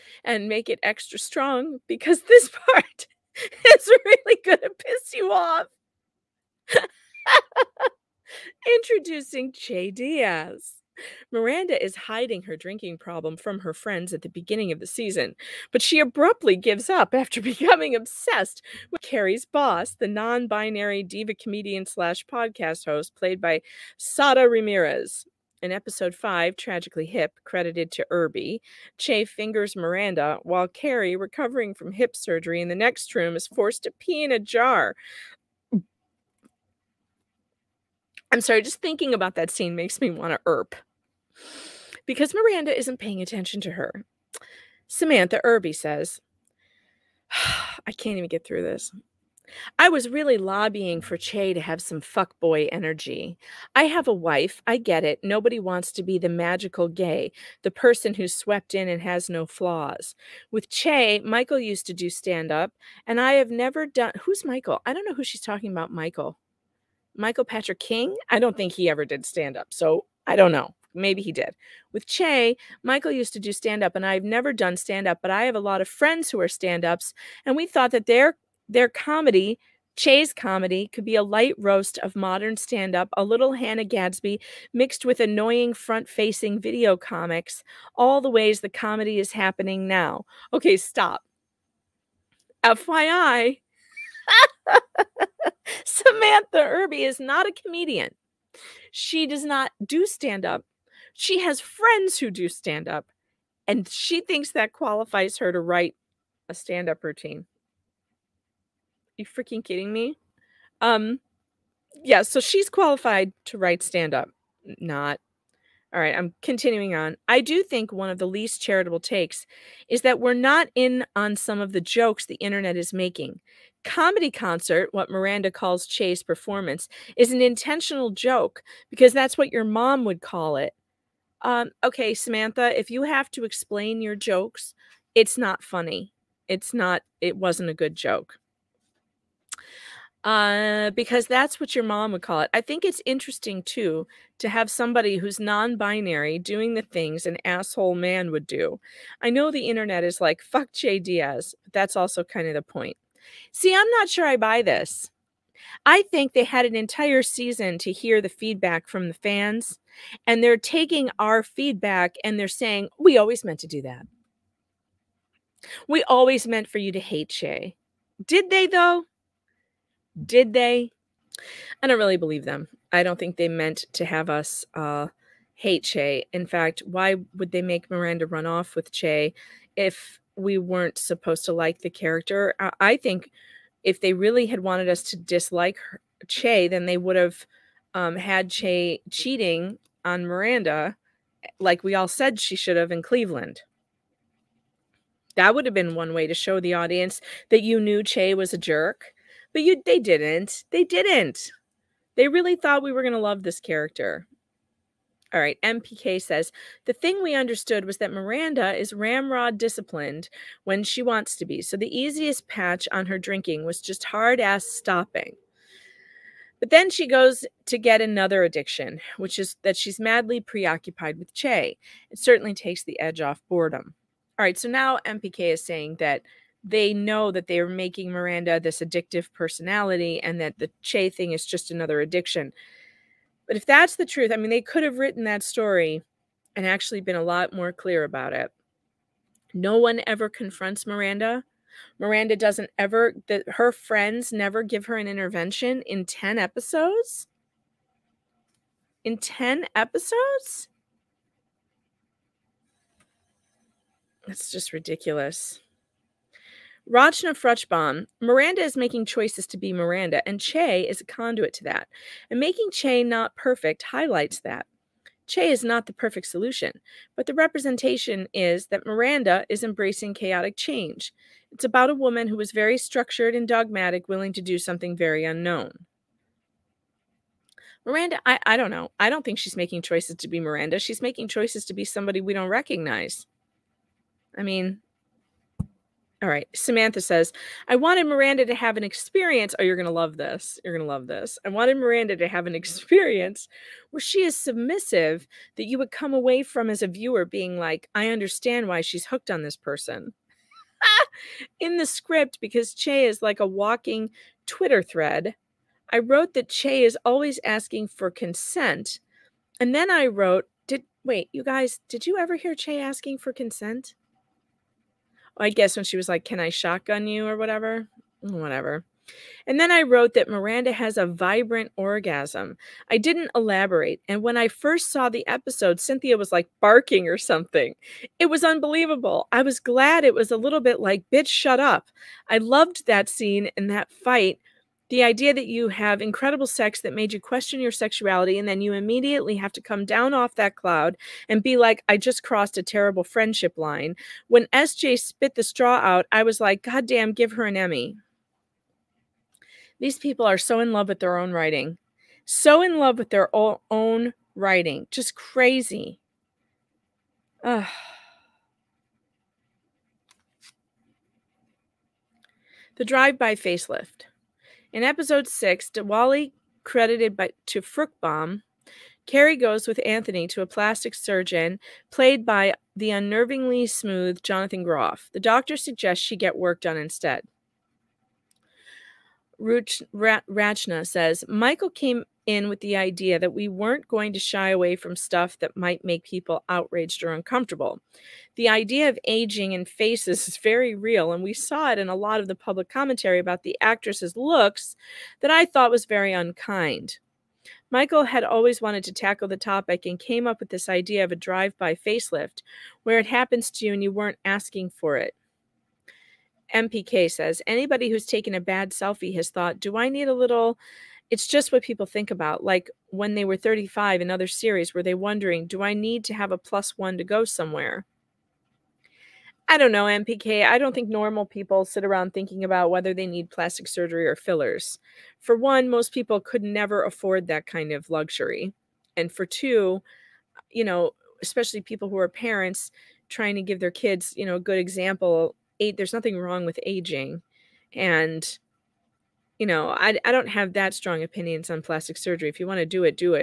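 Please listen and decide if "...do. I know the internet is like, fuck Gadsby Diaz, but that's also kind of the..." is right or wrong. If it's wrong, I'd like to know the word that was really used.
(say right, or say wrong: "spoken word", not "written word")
wrong: "Che", not "Gadsby".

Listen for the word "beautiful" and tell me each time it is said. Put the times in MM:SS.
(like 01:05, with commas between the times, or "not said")
not said.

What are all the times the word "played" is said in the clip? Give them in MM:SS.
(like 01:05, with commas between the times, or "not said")
00:23, 06:11.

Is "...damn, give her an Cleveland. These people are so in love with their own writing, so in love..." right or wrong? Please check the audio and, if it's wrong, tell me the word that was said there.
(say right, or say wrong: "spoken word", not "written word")
wrong: "Emmy", not "Cleveland".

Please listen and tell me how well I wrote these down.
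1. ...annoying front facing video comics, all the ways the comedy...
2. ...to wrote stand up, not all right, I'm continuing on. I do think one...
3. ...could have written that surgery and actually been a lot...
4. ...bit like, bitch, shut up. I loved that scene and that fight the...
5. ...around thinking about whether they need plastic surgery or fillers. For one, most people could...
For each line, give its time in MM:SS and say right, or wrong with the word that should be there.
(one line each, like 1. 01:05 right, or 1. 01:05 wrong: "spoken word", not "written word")
1. 01:25 right
2. 01:53 wrong: "write", not "wrote"
3. 03:54 wrong: "story", not "surgery"
4. 05:30 right
5. 07:01 right.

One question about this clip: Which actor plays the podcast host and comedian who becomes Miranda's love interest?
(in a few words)
Sara Ramirez.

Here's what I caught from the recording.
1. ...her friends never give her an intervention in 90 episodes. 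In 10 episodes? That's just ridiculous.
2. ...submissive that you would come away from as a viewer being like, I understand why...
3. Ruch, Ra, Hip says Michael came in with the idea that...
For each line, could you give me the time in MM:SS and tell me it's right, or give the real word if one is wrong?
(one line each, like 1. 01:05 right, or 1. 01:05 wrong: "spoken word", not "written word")
1. 04:03 wrong: "10", not "90"
2. 04:54 right
3. 06:19 wrong: "Rachna", not "Hip".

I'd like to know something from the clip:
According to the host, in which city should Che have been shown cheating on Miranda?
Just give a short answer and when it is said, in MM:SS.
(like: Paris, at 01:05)
Cleveland, at 03:13.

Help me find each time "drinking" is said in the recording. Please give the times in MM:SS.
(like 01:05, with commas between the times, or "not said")
00:12, 03:33.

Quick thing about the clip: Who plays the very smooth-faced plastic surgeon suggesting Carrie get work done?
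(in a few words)
Jonathan Groff.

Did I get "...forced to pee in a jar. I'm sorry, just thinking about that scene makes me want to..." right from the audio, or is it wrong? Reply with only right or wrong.
right.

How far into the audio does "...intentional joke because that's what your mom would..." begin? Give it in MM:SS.
02:07.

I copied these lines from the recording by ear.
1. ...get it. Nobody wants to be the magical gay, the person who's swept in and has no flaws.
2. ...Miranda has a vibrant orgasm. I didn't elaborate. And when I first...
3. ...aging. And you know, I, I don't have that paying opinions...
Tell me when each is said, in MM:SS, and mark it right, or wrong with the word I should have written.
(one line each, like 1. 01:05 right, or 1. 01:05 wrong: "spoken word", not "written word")
1. 00:54 right
2. 05:20 right
3. 07:16 wrong: "strong", not "paying".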